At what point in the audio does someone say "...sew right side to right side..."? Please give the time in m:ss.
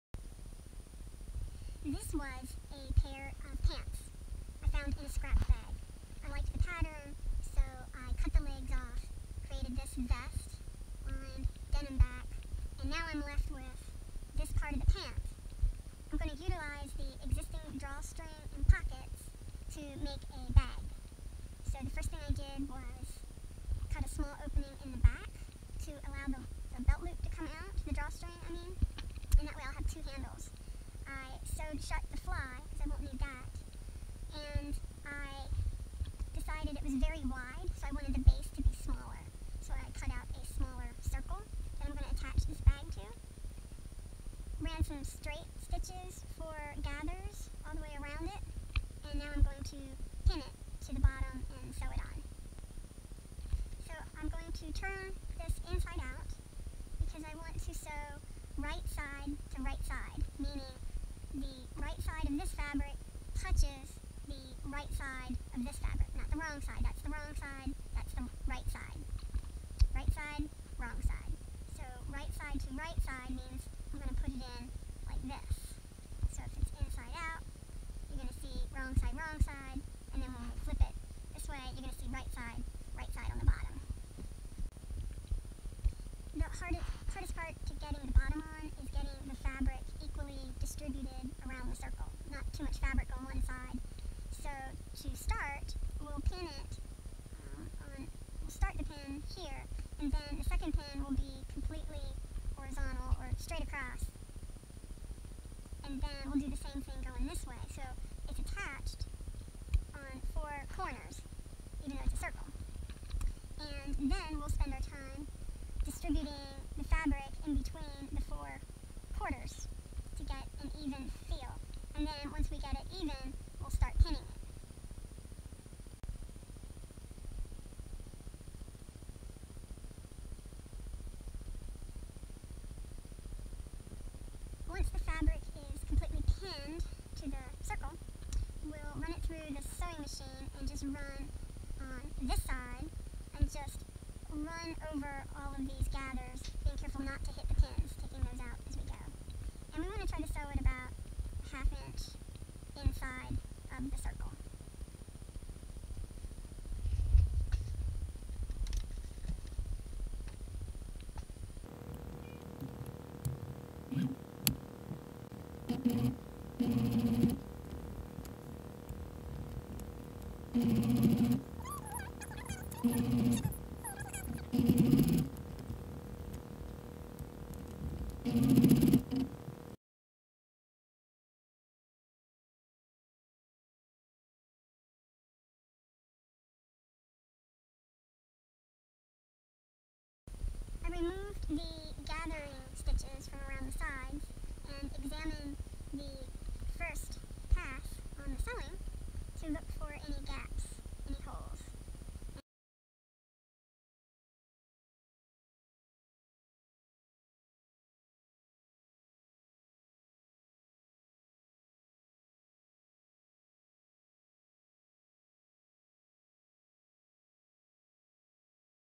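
0:57.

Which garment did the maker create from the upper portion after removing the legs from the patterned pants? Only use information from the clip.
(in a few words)
vest.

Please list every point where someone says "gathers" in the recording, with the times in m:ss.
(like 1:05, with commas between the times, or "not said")
0:46, 2:25.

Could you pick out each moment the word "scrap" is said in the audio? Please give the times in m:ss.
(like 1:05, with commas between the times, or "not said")
0:05.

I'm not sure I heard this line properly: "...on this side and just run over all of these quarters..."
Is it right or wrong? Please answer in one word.
wrong.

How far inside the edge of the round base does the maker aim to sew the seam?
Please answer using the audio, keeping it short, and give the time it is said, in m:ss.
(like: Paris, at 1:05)
half inch, at 2:31.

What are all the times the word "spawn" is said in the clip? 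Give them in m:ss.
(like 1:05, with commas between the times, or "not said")
not said.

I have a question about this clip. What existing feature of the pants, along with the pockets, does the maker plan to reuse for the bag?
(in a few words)
drawstring.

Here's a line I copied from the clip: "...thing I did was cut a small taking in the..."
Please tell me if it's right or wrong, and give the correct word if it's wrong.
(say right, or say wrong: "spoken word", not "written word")
wrong: "opening", not "taking".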